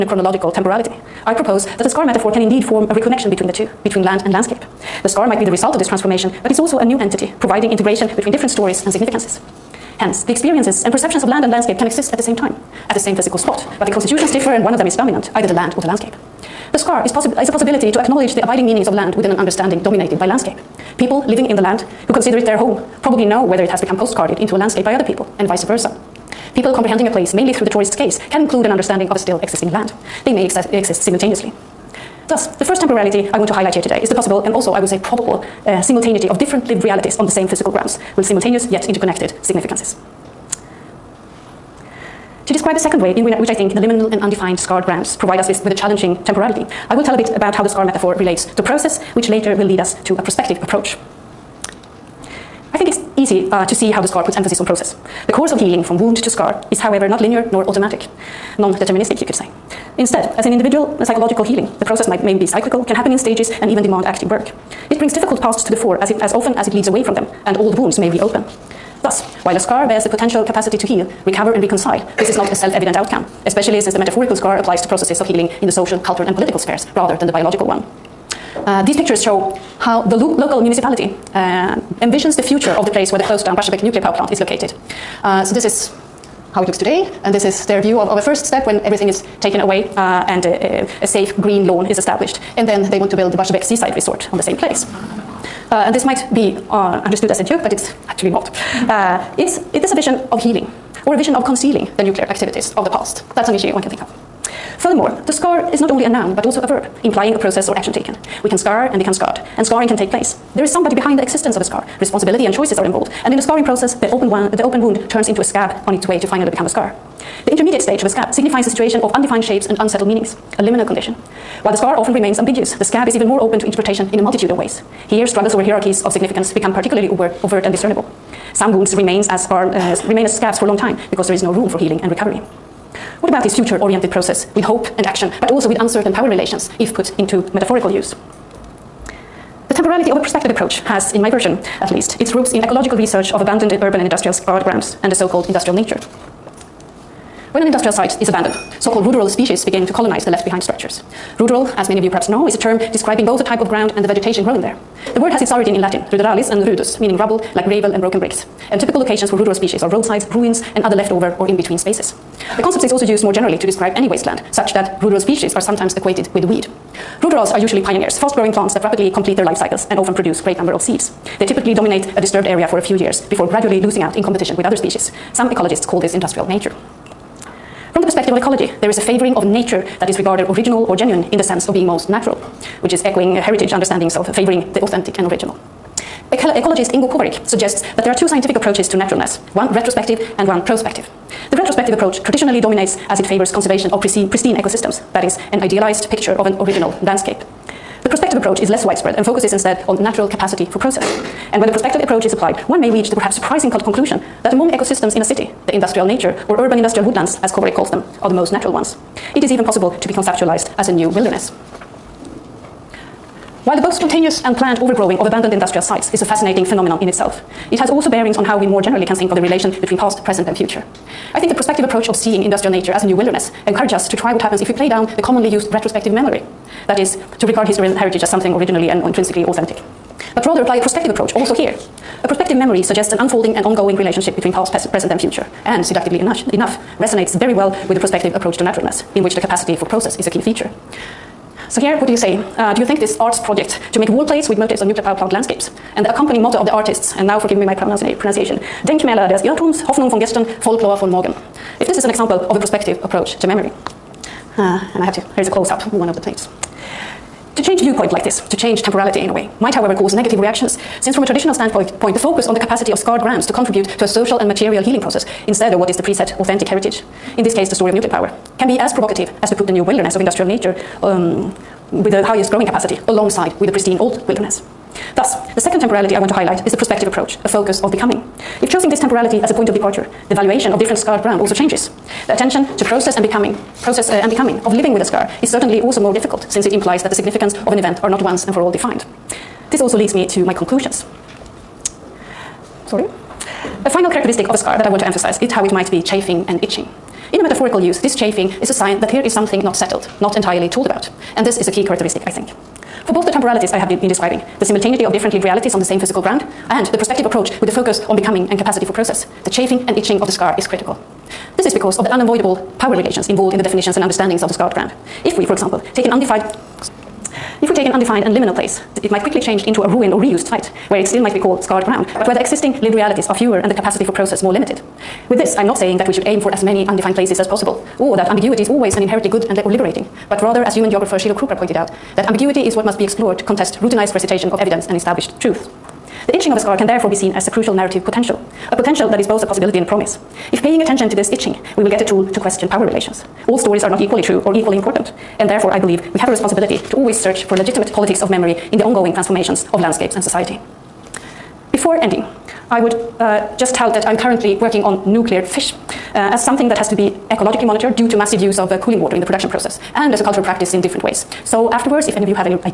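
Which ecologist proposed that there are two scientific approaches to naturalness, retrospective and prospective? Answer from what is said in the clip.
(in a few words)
Ingo Kowarik.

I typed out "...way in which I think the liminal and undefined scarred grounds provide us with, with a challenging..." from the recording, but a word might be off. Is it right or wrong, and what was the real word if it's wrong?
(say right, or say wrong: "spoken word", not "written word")
right.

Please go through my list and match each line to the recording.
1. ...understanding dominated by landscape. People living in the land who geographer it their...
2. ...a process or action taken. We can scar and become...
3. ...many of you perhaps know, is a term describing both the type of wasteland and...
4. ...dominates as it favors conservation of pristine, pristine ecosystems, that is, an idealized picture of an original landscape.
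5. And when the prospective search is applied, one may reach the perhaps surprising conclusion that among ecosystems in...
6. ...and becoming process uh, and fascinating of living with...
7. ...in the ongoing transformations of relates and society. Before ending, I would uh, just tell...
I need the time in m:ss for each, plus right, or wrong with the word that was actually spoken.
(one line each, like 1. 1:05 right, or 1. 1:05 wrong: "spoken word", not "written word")
1. 0:19 wrong: "consider", not "geographer"
2. 1:47 right
3. 2:31 wrong: "ground", not "wasteland"
4. 3:12 right
5. 3:21 wrong: "approach", not "search"
6. 4:43 wrong: "becoming", not "fascinating"
7. 5:48 wrong: "landscapes", not "relates".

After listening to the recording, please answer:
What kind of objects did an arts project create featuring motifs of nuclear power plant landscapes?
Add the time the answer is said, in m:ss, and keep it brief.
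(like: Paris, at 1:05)
Wall plates, at 4:04.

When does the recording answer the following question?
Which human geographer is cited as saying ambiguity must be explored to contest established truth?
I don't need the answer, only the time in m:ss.
5:31.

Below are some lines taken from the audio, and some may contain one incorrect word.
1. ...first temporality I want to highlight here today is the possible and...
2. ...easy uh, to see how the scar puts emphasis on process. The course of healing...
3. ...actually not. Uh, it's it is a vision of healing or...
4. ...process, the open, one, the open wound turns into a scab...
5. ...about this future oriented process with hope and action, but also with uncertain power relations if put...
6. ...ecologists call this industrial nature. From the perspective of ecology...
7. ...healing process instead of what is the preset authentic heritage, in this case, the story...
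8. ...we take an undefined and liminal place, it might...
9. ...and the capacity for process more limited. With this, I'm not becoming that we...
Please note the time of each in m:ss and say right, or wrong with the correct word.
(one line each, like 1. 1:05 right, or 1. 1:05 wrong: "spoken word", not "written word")
1. 0:32 right
2. 0:53 right
3. 1:38 right
4. 1:53 right
5. 2:13 right
6. 2:55 right
7. 4:24 right
8. 5:17 right
9. 5:23 wrong: "saying", not "becoming".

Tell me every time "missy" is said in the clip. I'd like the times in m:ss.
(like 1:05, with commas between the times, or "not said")
not said.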